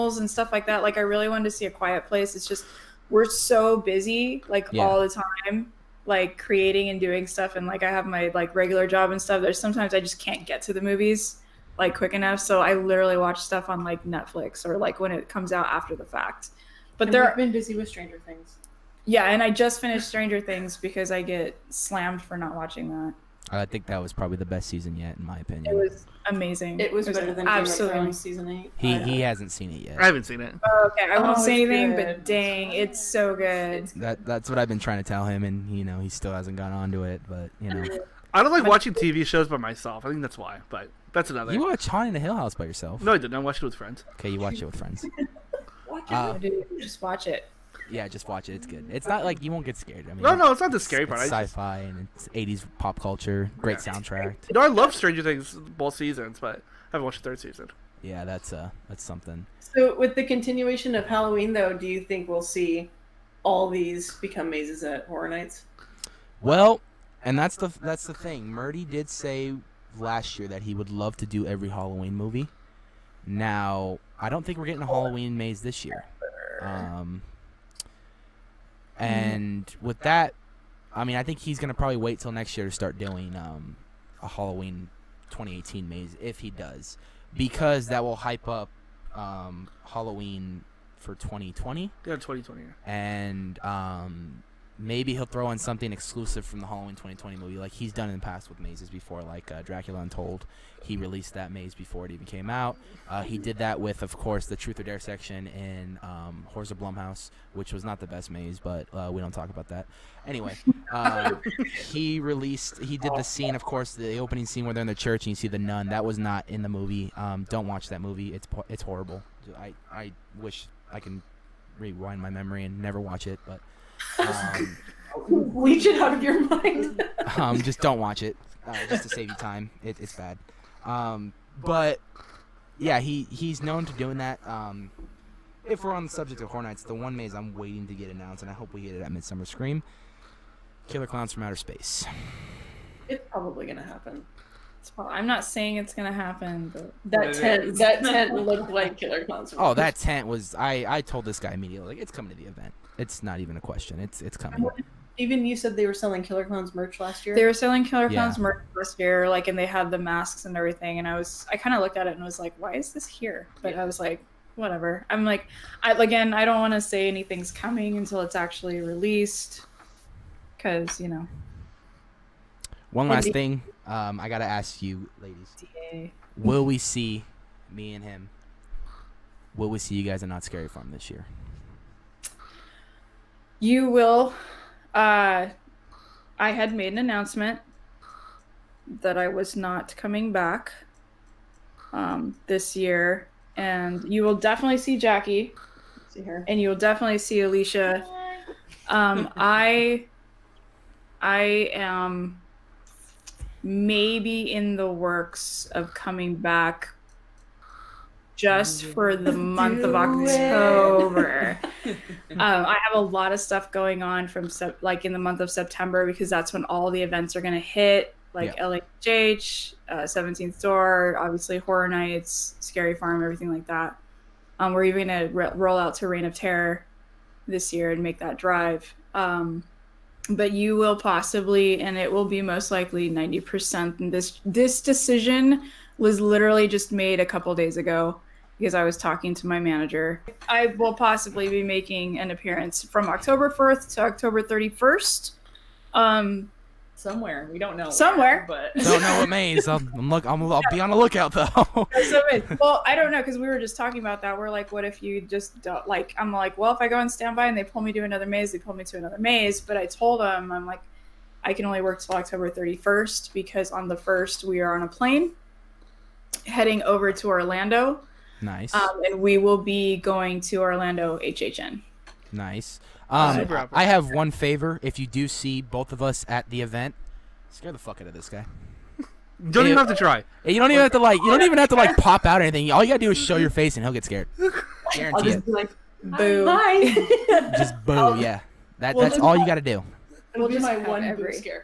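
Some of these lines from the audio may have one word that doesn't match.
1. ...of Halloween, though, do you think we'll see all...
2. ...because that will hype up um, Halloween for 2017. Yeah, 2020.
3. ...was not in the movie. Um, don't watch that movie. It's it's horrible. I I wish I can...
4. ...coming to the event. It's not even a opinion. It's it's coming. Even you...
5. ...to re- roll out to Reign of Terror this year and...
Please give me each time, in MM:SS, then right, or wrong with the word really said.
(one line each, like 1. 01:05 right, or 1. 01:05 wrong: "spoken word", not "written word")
1. 01:00 right
2. 01:27 wrong: "2020", not "2017"
3. 01:56 right
4. 02:32 wrong: "question", not "opinion"
5. 03:45 right.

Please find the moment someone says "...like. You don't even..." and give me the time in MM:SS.
04:40.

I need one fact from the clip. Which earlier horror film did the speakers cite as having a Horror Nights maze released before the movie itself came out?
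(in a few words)
Dracula Untold.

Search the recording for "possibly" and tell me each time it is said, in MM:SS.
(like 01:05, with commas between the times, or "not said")
03:50, 04:00.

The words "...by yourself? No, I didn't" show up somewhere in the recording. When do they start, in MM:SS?
00:42.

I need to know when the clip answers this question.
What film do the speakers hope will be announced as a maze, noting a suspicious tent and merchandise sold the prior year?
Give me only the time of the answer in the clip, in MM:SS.
02:20.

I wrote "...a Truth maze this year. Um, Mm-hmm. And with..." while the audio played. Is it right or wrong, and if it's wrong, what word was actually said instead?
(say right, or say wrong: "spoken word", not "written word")
wrong: "Halloween", not "Truth".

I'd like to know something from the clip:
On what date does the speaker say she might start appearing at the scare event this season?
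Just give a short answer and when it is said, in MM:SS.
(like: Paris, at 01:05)
October 4th, at 04:03.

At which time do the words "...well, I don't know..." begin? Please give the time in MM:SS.
04:12.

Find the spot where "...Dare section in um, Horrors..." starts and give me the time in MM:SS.
01:44.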